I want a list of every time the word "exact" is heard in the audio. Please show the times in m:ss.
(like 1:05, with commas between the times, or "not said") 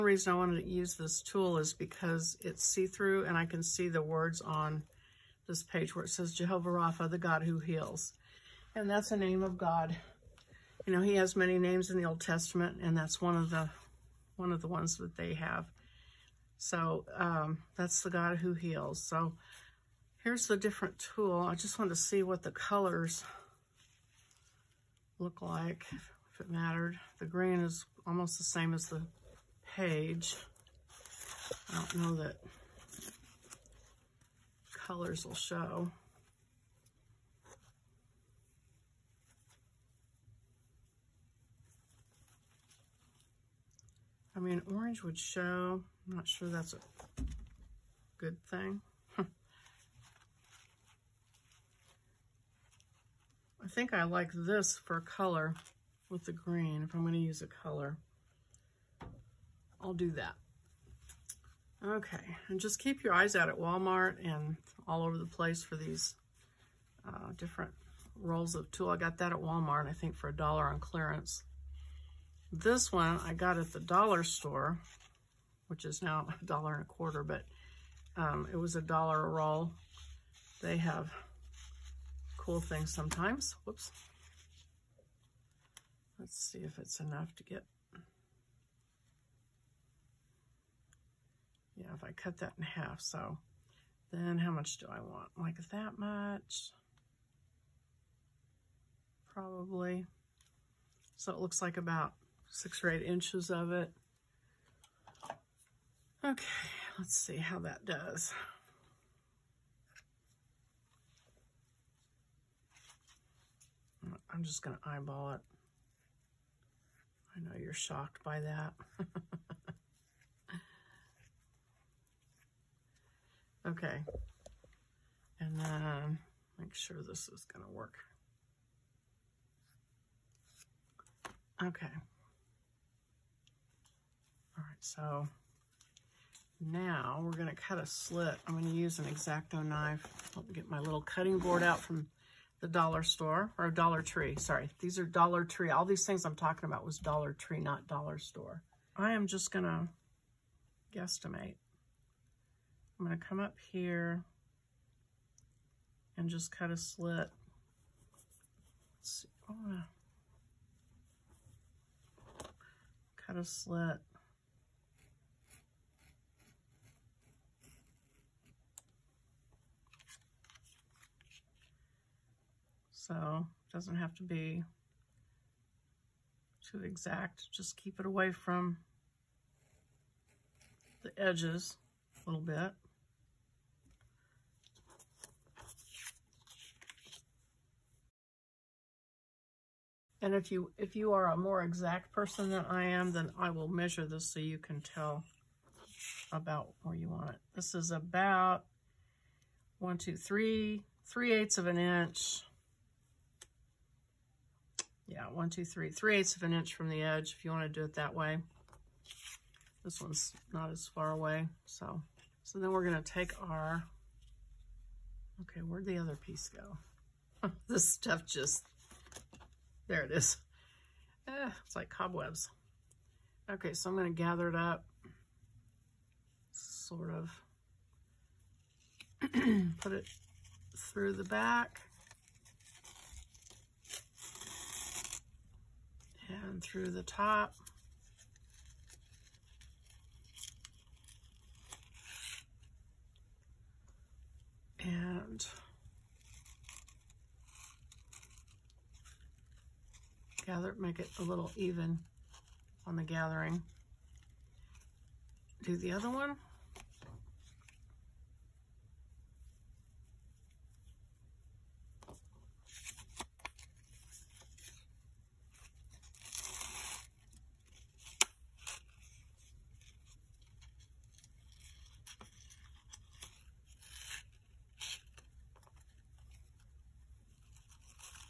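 2:56, 3:11.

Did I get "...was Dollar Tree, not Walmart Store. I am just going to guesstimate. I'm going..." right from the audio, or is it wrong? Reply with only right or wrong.
wrong.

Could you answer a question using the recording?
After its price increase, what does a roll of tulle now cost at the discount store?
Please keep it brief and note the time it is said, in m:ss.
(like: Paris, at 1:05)
a dollar and a quarter, at 1:16.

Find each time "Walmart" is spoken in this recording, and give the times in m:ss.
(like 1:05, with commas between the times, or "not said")
1:03, 1:09.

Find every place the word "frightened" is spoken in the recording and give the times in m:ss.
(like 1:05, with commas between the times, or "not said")
not said.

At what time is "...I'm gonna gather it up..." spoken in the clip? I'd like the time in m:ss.
3:43.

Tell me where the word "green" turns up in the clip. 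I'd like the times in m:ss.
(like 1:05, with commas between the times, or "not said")
0:27, 0:56.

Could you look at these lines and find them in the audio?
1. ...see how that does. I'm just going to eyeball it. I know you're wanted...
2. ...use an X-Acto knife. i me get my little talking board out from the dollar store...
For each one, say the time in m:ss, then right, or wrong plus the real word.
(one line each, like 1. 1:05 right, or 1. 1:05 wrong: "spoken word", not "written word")
1. 1:47 wrong: "shocked", not "wanted"
2. 2:18 wrong: "cutting", not "talking".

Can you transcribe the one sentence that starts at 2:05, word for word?
And then make sure this is going to work.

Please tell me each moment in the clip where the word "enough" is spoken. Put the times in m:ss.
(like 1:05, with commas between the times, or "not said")
1:27.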